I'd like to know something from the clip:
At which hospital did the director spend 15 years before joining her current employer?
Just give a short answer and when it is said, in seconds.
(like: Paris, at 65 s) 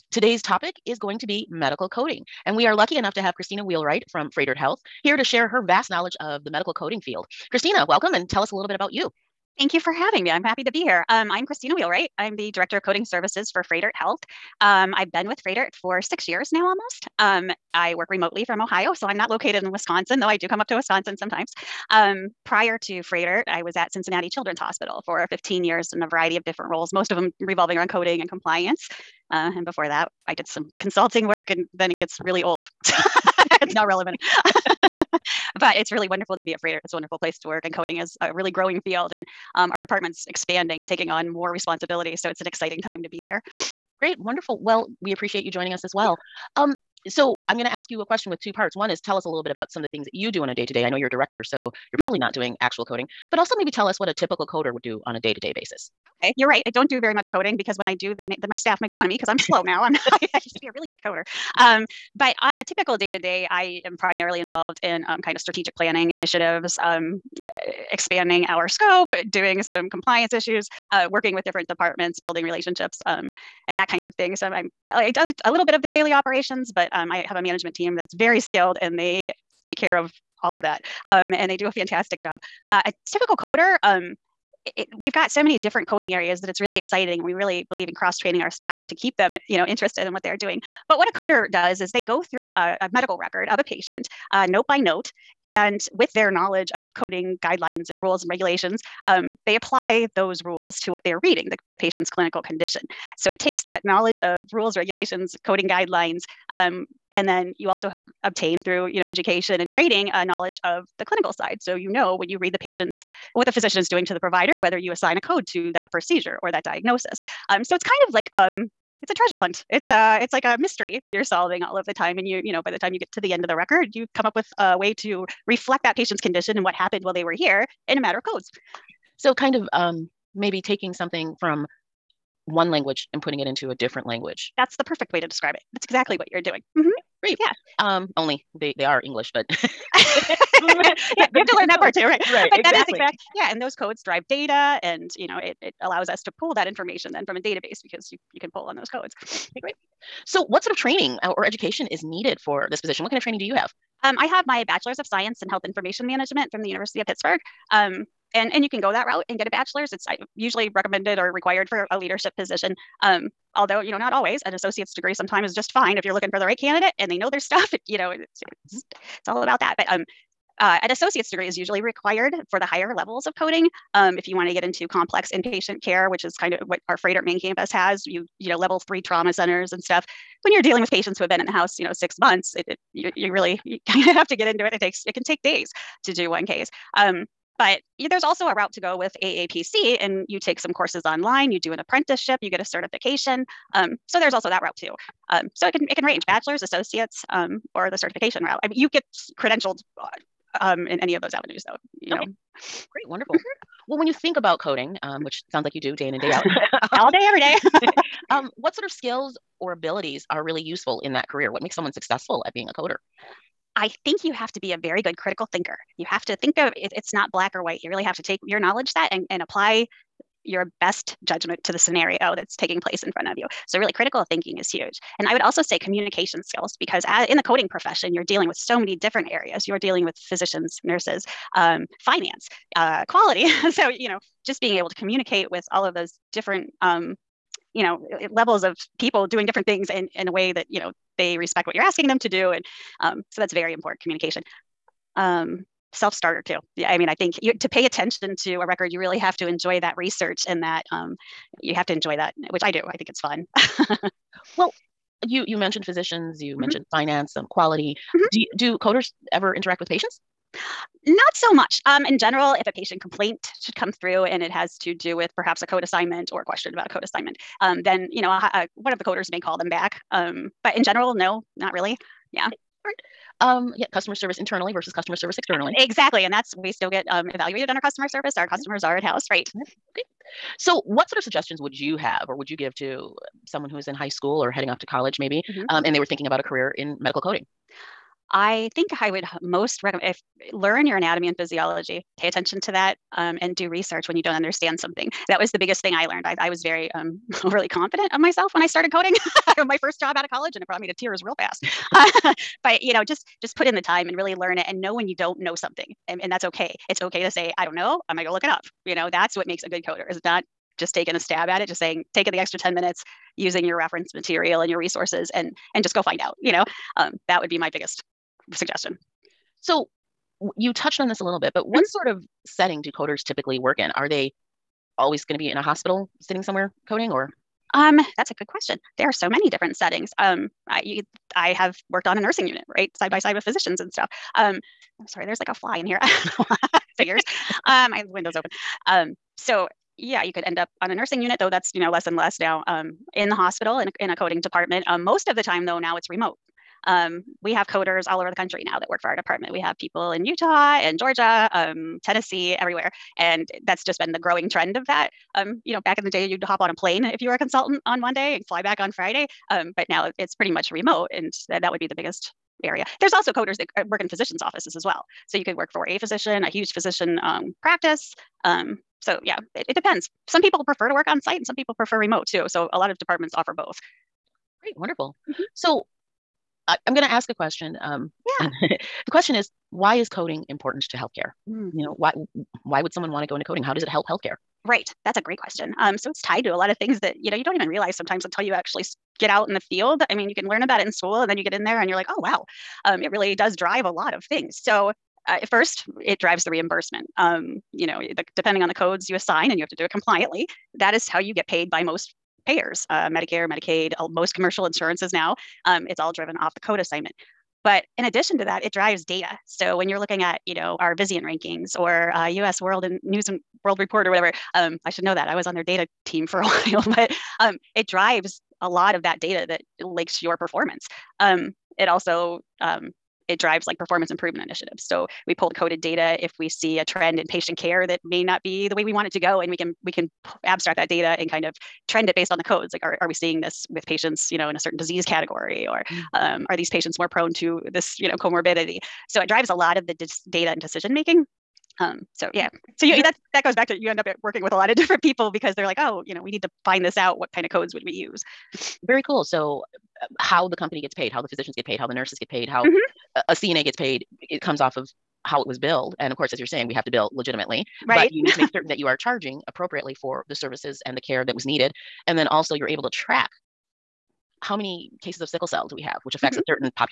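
Cincinnati Children's Hospital, at 23 s.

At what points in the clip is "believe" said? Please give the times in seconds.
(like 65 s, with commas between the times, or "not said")
87 s.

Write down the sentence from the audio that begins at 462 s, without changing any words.
And then also you're able to track how many cases of sickle cell do we have, which affects mm-hmm.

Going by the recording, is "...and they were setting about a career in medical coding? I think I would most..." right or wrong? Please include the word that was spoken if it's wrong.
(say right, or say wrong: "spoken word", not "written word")
wrong: "thinking", not "setting".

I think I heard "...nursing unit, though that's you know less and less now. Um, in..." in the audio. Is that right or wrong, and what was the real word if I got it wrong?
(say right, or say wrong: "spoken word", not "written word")
right.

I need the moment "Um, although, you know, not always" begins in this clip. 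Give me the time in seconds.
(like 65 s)
163 s.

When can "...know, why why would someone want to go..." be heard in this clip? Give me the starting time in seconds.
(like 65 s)
381 s.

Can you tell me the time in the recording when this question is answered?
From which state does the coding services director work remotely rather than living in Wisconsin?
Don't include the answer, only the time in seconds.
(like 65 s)
18 s.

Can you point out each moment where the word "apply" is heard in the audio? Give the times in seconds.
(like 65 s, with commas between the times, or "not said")
99 s, 219 s.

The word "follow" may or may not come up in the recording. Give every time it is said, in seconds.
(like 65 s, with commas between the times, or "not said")
not said.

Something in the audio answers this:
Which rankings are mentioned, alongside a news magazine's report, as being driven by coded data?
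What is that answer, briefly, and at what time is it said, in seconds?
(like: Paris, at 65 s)
Vizient, at 410 s.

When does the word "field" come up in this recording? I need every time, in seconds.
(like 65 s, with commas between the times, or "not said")
7 s, 38 s, 389 s.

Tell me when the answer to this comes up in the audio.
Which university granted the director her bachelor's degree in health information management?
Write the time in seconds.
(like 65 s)
156 s.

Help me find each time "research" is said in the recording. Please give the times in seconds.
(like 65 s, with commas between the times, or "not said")
249 s, 293 s.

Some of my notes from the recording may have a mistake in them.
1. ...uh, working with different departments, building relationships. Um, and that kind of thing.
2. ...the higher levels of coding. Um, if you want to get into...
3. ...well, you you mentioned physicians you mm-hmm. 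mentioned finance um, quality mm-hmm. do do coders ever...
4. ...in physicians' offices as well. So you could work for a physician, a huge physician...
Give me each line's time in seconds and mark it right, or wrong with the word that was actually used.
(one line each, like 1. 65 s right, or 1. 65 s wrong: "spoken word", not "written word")
1. 70 s right
2. 172 s right
3. 254 s right
4. 363 s right.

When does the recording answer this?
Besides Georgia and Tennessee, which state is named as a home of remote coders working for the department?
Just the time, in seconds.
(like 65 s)
350 s.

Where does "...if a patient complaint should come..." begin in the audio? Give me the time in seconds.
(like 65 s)
262 s.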